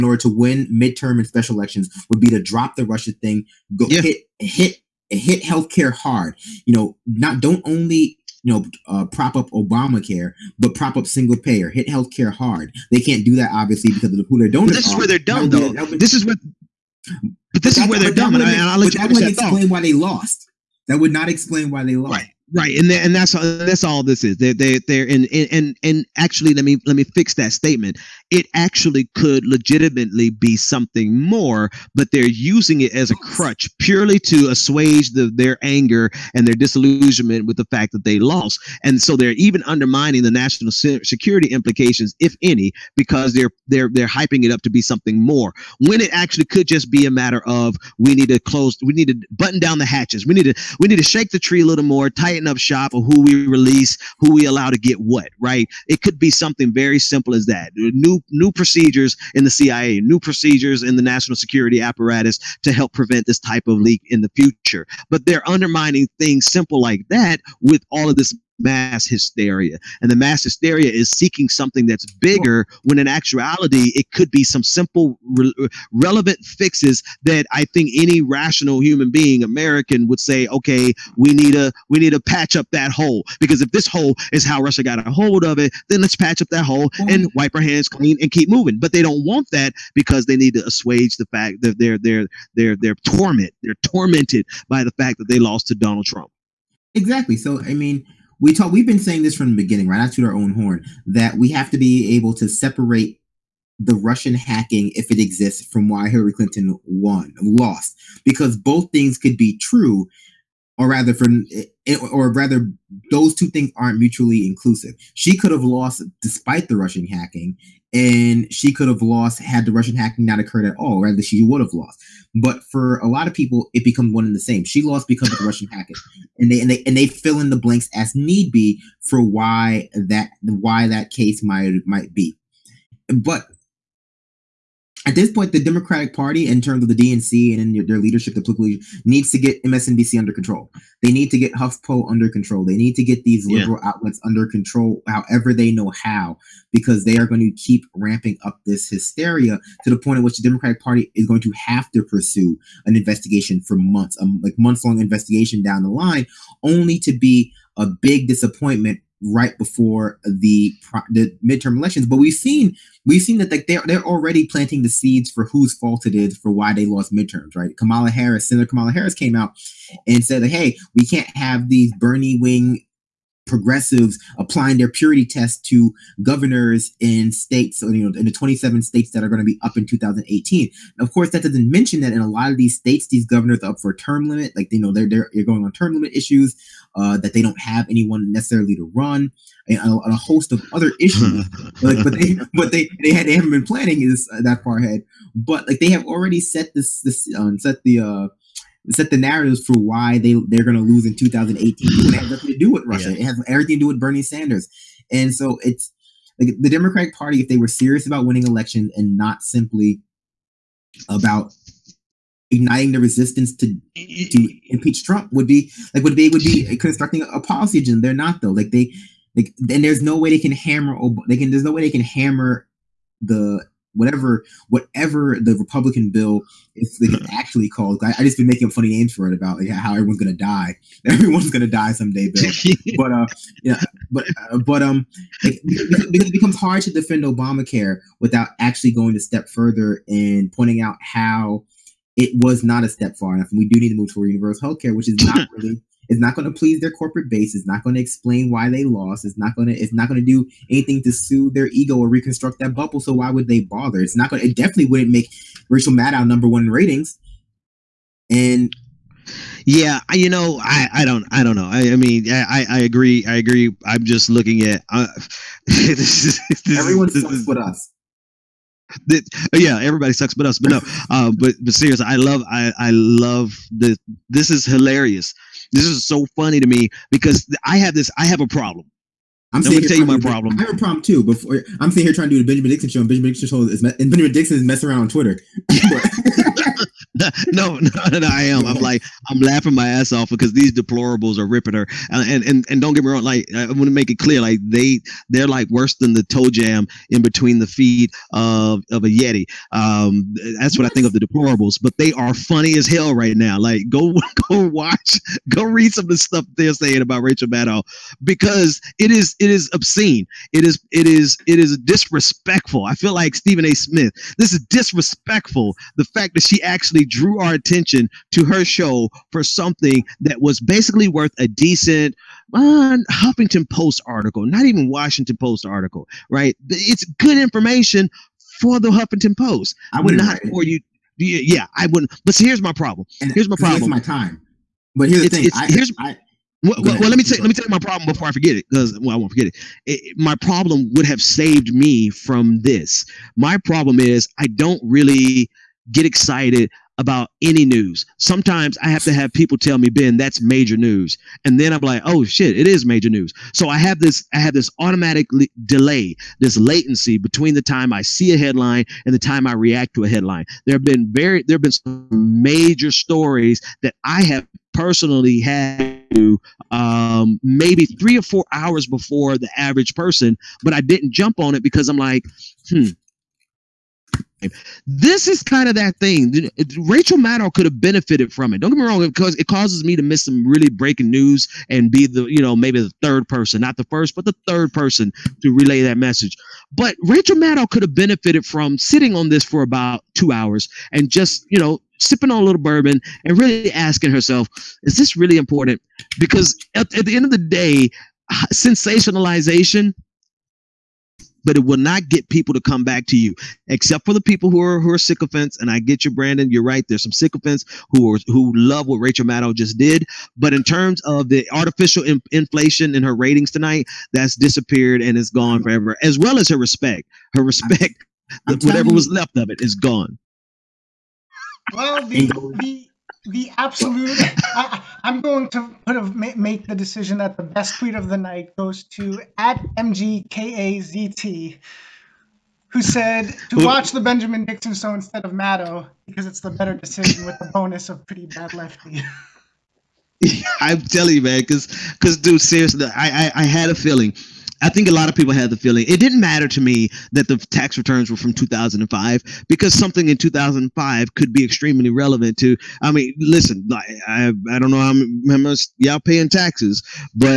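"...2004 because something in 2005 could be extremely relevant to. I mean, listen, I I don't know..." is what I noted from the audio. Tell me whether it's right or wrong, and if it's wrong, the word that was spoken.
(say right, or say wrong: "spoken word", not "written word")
wrong: "2005", not "2004".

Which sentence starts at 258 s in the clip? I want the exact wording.
And yeah, you know, I, I don't I don't know.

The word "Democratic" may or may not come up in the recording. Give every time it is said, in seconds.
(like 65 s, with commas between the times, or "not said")
135 s, 150 s, 206 s.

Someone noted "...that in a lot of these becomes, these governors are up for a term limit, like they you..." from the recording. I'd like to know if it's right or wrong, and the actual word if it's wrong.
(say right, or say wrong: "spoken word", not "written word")
wrong: "states", not "becomes".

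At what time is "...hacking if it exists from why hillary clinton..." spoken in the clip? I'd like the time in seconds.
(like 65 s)
104 s.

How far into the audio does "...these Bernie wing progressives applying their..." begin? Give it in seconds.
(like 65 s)
171 s.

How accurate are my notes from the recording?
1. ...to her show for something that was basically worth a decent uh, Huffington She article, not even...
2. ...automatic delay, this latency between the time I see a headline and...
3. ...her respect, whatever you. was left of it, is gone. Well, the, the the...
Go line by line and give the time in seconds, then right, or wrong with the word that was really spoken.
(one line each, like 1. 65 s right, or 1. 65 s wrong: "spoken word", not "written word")
1. 318 s wrong: "Post", not "She"
2. 354 s right
3. 417 s right.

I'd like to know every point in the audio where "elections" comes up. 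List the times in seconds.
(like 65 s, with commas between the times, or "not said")
1 s, 161 s, 208 s.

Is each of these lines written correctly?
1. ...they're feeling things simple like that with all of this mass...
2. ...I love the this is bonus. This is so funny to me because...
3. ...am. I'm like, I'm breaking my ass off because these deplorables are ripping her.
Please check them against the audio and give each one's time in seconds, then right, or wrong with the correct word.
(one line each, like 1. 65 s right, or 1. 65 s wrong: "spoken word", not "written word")
1. 65 s wrong: "undermining", not "feeling"
2. 272 s wrong: "hilarious", not "bonus"
3. 288 s wrong: "laughing", not "breaking".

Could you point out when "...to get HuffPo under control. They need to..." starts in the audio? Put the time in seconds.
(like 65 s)
141 s.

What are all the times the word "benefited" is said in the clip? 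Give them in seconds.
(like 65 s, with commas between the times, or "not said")
377 s, 387 s.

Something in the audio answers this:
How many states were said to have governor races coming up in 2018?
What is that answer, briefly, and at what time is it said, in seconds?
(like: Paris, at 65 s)
27, at 178 s.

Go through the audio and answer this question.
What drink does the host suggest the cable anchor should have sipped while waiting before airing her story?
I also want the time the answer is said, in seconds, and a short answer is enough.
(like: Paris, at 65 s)
bourbon, at 392 s.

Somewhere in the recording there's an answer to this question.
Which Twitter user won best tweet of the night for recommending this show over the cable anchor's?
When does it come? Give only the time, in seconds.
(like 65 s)
429 s.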